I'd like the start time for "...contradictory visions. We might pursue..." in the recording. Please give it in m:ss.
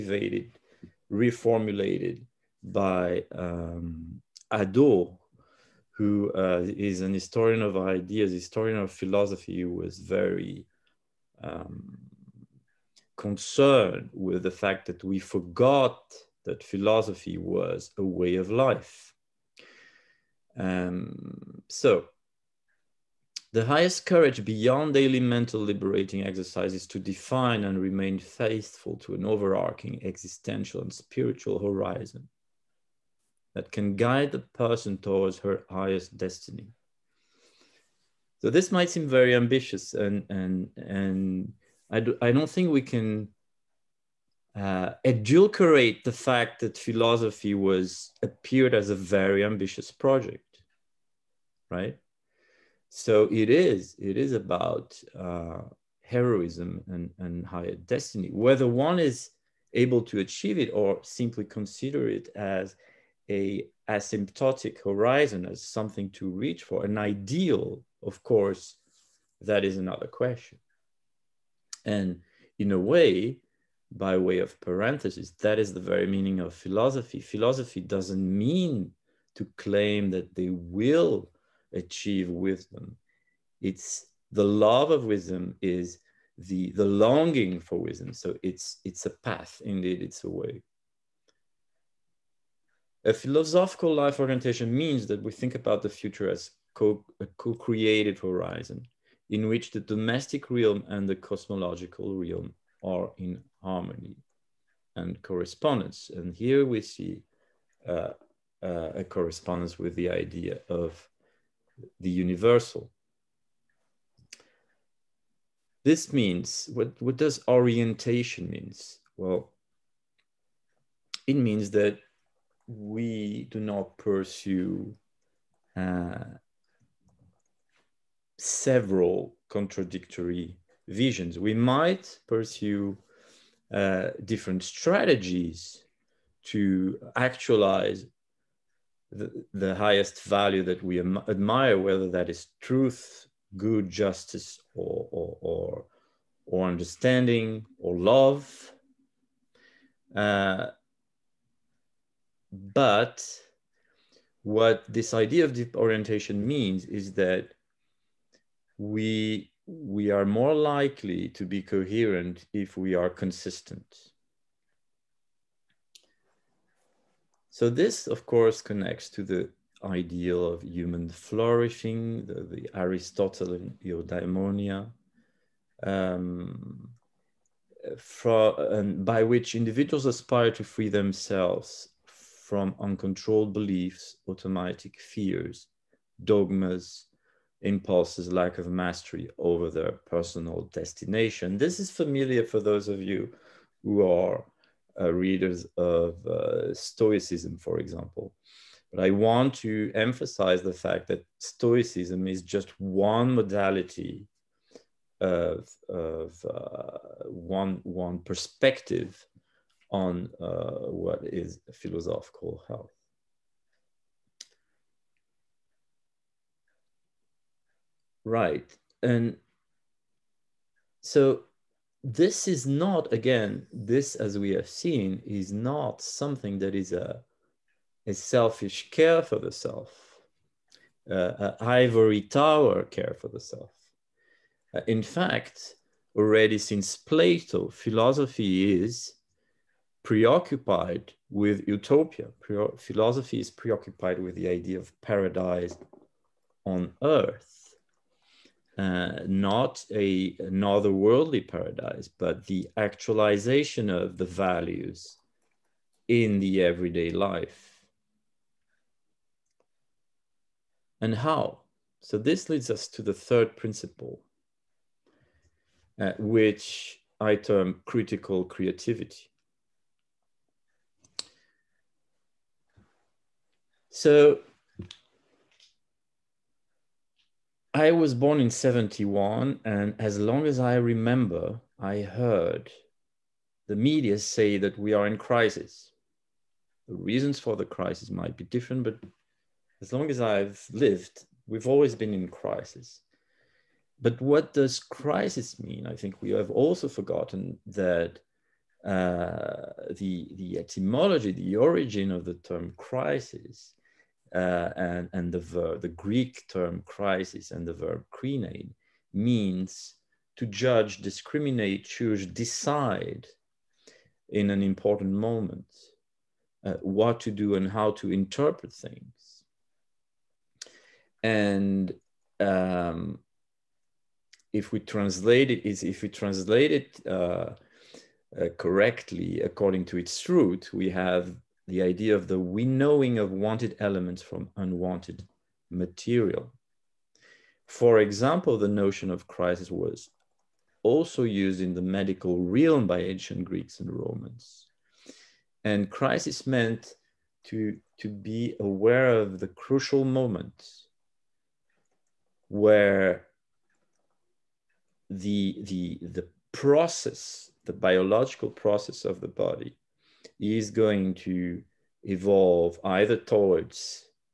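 2:09.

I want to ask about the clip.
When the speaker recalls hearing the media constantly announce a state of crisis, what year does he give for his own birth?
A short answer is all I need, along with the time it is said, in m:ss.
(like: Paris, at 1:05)
1971, at 4:38.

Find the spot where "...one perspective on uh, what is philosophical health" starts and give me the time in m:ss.
3:27.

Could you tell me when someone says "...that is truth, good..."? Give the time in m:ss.
2:22.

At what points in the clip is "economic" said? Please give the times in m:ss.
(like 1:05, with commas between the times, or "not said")
not said.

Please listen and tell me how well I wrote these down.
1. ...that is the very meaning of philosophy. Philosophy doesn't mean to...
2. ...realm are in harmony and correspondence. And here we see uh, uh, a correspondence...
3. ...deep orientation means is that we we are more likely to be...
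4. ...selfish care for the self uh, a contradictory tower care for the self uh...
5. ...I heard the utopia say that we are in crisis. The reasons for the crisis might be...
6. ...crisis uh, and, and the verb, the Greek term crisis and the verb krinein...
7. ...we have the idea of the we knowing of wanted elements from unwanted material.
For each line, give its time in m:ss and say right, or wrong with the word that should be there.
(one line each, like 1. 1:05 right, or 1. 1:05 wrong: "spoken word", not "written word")
1. 1:15 right
2. 1:42 right
3. 2:35 right
4. 3:48 wrong: "ivory", not "contradictory"
5. 4:41 wrong: "media", not "utopia"
6. 5:02 right
7. 5:30 right.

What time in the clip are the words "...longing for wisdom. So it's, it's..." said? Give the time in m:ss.
1:26.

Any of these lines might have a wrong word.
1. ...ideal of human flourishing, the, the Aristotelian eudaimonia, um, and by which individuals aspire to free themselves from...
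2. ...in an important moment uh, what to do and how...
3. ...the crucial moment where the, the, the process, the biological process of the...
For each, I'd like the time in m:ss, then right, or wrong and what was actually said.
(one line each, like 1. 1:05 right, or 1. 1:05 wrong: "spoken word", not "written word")
1. 2:49 right
2. 5:14 right
3. 5:49 right.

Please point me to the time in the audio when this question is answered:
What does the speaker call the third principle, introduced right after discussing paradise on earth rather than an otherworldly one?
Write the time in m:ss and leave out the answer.
4:27.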